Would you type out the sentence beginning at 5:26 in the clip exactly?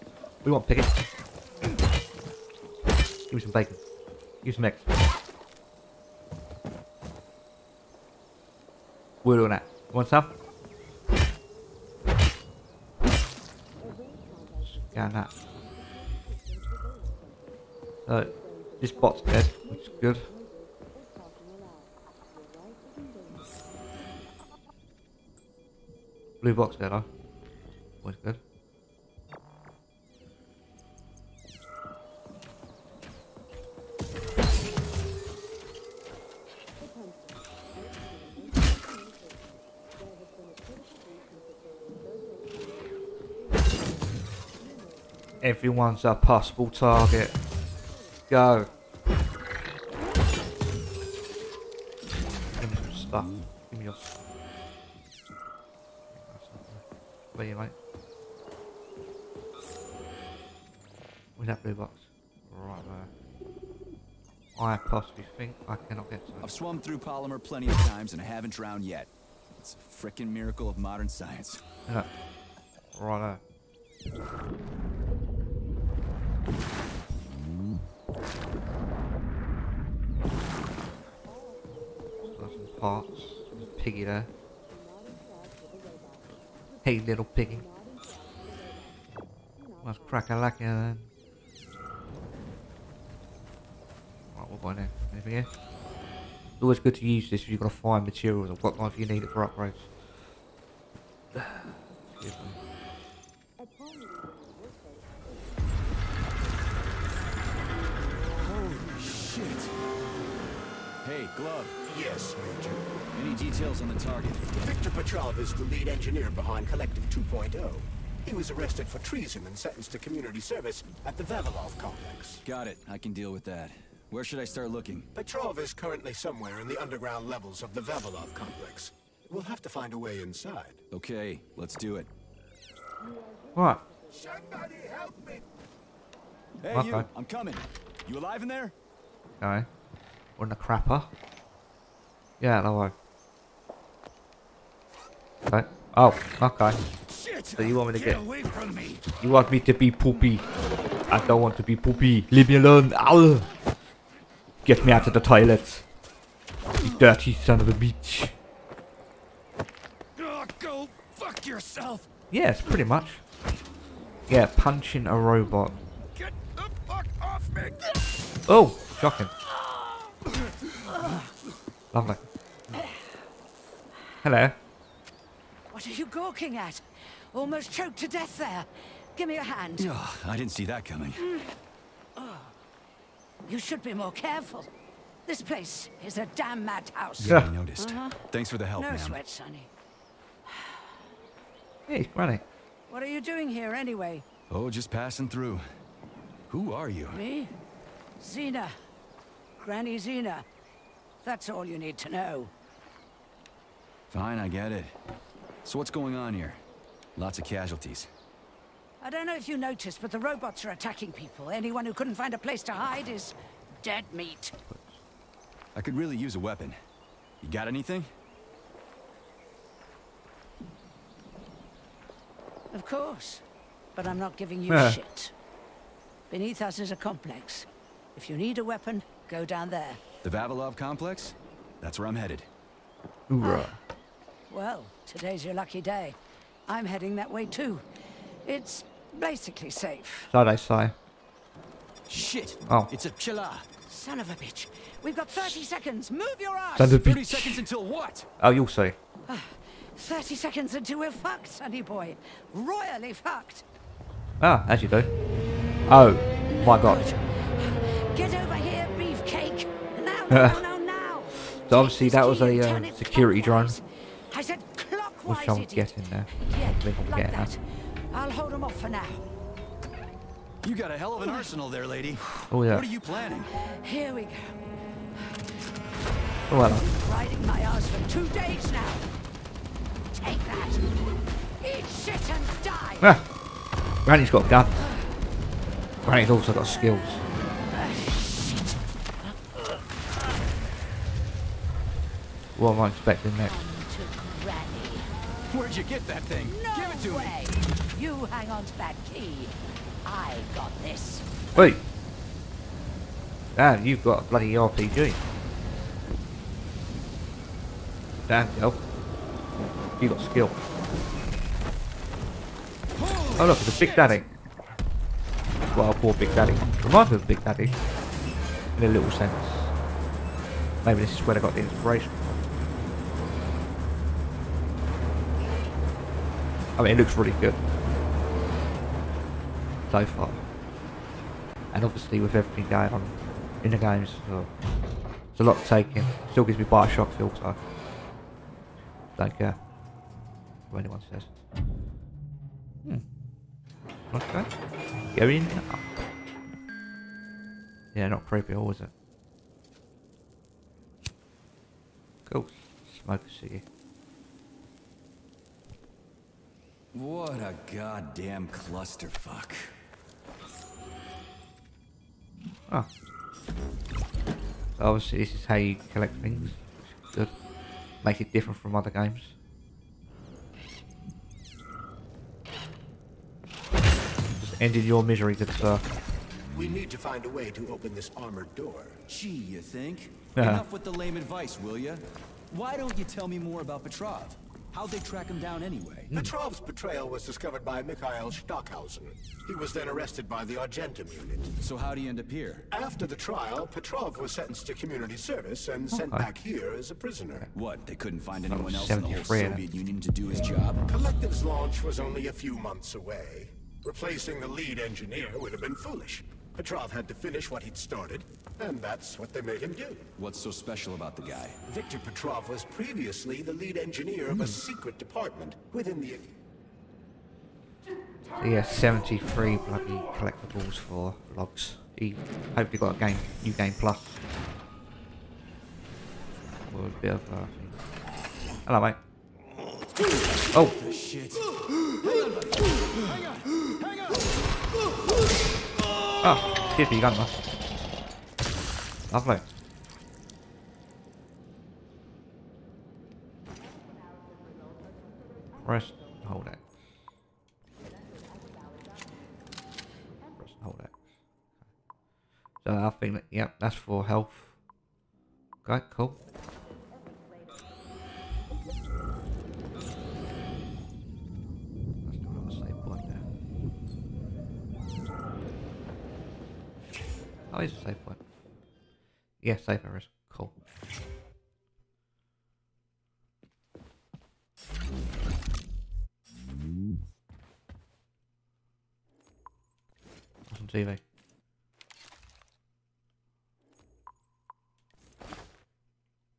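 I mean, it looks really good so far.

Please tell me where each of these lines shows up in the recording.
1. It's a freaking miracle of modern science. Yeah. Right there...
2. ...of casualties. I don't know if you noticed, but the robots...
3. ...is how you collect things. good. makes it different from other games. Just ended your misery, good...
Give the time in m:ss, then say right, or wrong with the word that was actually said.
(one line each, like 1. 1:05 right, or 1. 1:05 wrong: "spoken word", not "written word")
1. 1:09 right
2. 3:27 right
3. 6:05 right.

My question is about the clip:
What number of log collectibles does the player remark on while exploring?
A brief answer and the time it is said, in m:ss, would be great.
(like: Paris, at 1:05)
73, at 6:58.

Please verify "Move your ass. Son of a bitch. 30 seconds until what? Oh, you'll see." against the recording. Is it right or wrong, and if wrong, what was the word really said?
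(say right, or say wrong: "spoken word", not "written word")
right.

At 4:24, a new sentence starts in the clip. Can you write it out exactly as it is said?
I said Which I'm guessing there.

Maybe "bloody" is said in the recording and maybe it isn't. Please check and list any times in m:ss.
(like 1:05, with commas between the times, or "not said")
5:04, 6:59.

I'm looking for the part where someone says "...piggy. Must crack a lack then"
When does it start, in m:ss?
1:27.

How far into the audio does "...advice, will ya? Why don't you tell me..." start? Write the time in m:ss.
6:21.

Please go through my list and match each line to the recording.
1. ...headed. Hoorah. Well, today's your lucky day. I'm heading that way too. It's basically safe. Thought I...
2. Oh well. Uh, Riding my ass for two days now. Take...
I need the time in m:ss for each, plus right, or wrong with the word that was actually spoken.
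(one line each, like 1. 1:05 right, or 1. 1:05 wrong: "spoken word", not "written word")
1. 3:52 right
2. 4:36 right.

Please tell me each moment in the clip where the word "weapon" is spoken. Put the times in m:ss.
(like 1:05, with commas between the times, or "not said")
3:36, 3:48.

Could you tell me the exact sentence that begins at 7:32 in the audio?
So I think that, yep, that's for health.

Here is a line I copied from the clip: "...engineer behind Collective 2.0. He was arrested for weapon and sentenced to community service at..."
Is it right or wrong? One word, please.
wrong.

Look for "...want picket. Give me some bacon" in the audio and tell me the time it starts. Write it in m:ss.
0:00.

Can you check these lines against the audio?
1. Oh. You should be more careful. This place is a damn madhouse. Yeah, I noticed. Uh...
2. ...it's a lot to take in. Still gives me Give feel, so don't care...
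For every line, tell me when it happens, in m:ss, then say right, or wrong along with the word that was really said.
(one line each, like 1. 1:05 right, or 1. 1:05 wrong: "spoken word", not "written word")
1. 3:02 right
2. 5:35 wrong: "Bioshock", not "Give".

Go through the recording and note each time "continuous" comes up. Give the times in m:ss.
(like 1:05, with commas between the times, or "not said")
not said.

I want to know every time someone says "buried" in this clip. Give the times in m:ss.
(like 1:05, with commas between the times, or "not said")
not said.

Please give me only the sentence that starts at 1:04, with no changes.
I possibly think I cannot get to it.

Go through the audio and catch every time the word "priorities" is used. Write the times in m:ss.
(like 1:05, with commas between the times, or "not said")
not said.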